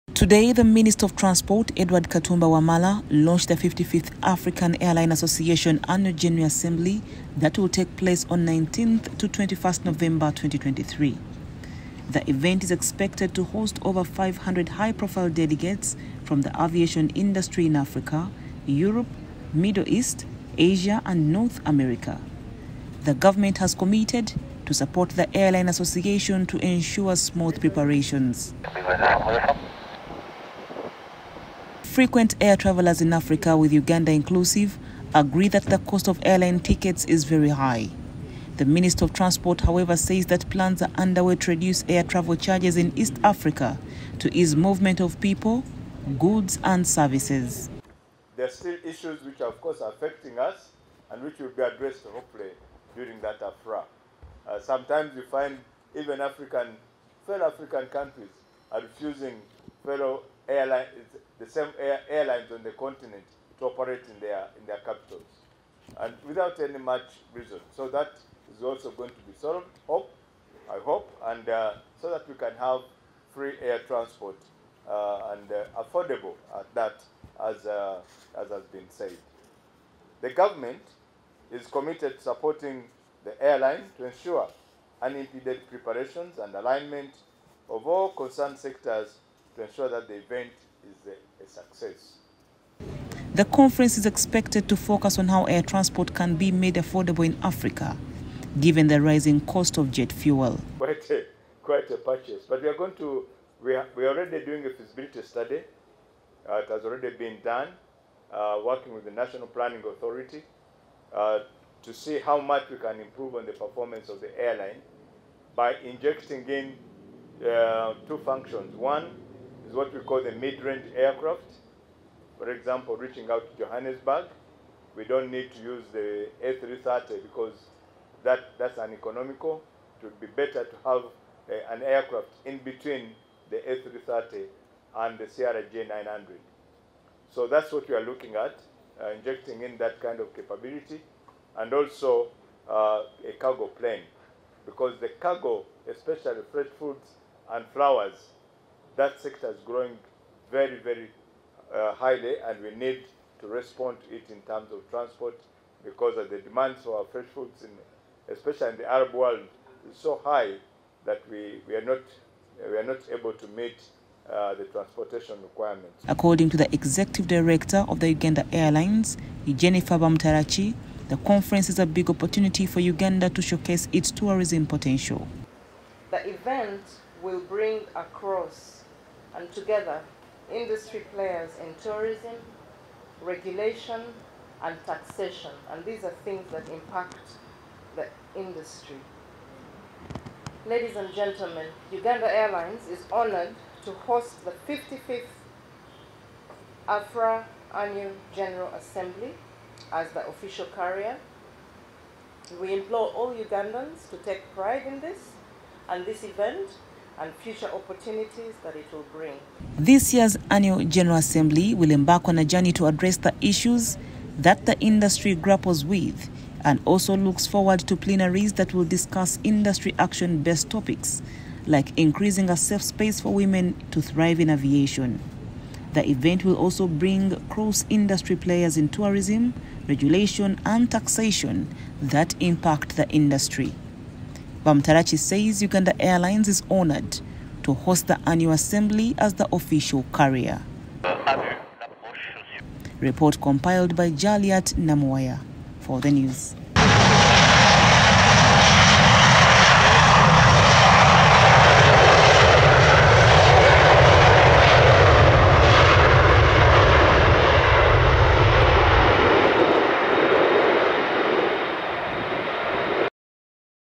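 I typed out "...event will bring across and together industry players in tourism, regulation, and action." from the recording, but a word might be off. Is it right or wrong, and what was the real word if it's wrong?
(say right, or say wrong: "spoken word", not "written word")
wrong: "taxation", not "action".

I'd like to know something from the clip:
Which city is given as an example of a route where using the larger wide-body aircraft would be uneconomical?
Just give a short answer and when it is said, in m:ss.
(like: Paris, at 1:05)
Johannesburg, at 2:03.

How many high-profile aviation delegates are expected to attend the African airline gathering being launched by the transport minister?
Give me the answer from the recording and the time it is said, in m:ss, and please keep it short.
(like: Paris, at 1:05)
over 500, at 0:13.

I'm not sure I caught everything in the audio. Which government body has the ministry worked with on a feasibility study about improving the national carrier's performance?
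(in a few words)
National Planning Authority.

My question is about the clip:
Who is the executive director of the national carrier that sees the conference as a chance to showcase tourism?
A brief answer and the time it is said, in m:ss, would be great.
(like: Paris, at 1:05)
Jennifer Bamuturaki, at 2:49.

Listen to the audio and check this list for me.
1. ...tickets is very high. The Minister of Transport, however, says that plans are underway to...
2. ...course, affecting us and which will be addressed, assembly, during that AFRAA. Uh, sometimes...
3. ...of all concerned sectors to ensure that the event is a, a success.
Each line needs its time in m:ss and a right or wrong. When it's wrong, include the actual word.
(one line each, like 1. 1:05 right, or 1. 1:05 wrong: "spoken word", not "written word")
1. 0:36 right
2. 0:49 wrong: "hopefully", not "assembly"
3. 1:27 right.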